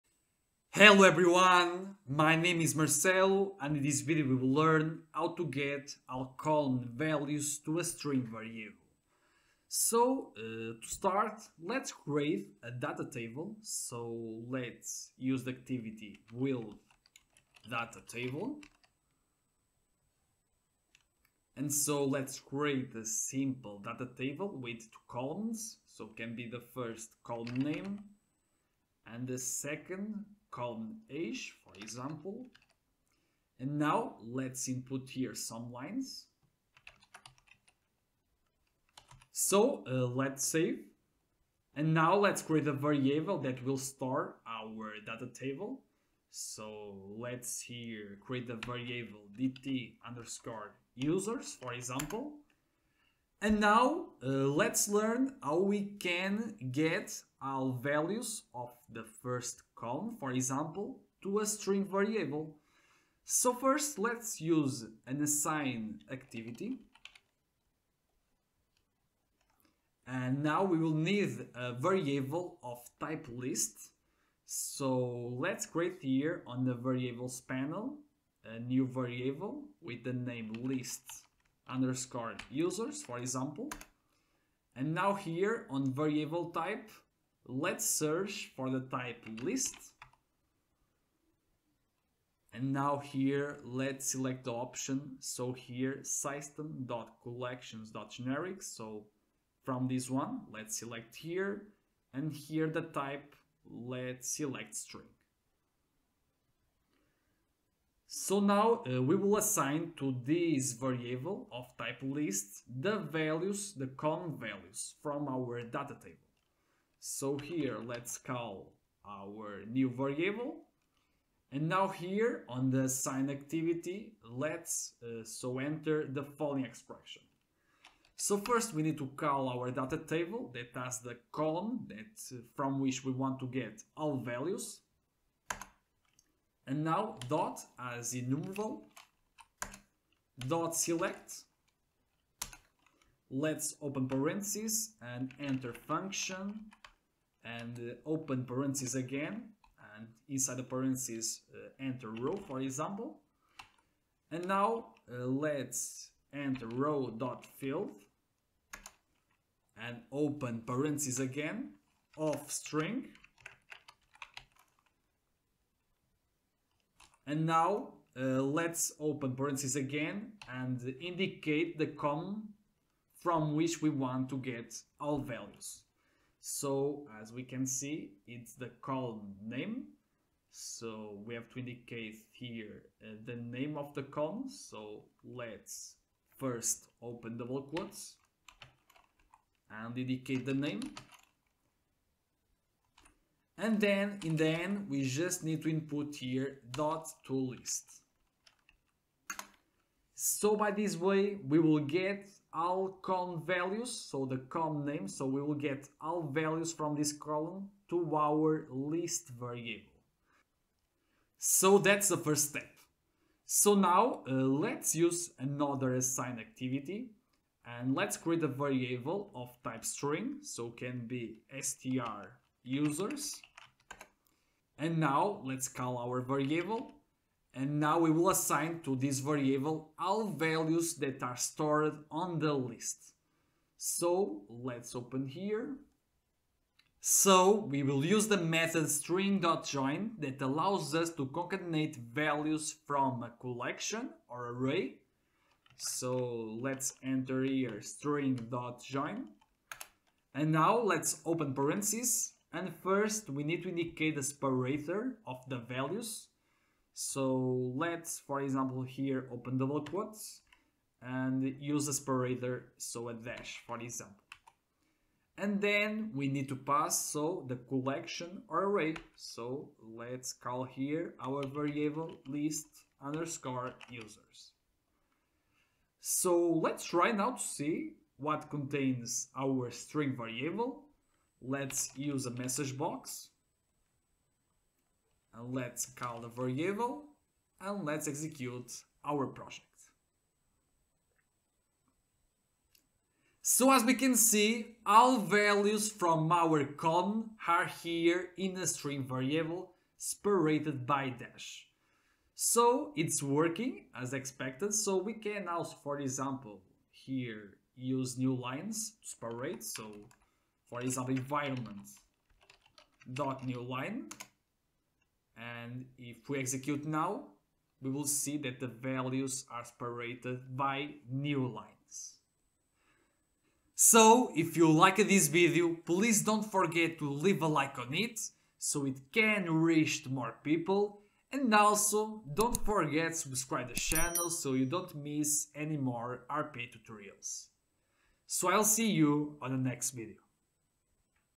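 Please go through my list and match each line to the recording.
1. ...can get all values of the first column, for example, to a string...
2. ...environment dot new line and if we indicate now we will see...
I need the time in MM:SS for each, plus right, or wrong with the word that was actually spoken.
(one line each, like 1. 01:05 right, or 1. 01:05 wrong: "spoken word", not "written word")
1. 00:55 right
2. 05:11 wrong: "execute", not "indicate".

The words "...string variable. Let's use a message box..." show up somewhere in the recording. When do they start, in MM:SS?
04:39.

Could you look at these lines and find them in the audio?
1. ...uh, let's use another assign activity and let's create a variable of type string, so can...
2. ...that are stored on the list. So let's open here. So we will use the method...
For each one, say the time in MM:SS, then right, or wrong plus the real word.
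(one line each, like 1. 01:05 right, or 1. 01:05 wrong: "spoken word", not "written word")
1. 03:34 right
2. 03:50 right.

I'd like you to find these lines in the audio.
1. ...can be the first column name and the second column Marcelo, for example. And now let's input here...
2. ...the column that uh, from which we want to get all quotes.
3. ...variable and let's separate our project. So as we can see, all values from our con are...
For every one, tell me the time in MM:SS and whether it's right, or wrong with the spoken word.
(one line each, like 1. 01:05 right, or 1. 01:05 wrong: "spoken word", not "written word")
1. 00:26 wrong: "Age", not "Marcelo"
2. 02:10 wrong: "values", not "quotes"
3. 04:46 wrong: "execute", not "separate".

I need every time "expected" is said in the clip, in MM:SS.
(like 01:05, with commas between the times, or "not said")
05:04.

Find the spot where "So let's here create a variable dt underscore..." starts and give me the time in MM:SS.
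00:46.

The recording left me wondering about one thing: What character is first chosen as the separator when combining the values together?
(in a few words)
a dash.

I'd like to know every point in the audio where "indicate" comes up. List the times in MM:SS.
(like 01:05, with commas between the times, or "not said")
02:51, 03:01, 03:09, 04:13.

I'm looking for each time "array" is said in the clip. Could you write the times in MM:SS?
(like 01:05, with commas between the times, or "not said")
04:04, 04:28.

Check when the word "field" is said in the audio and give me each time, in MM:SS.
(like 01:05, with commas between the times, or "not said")
02:37.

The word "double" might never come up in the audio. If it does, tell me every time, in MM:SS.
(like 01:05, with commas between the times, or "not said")
03:07, 04:19.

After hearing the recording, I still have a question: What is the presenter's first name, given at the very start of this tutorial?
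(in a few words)
Marcelo.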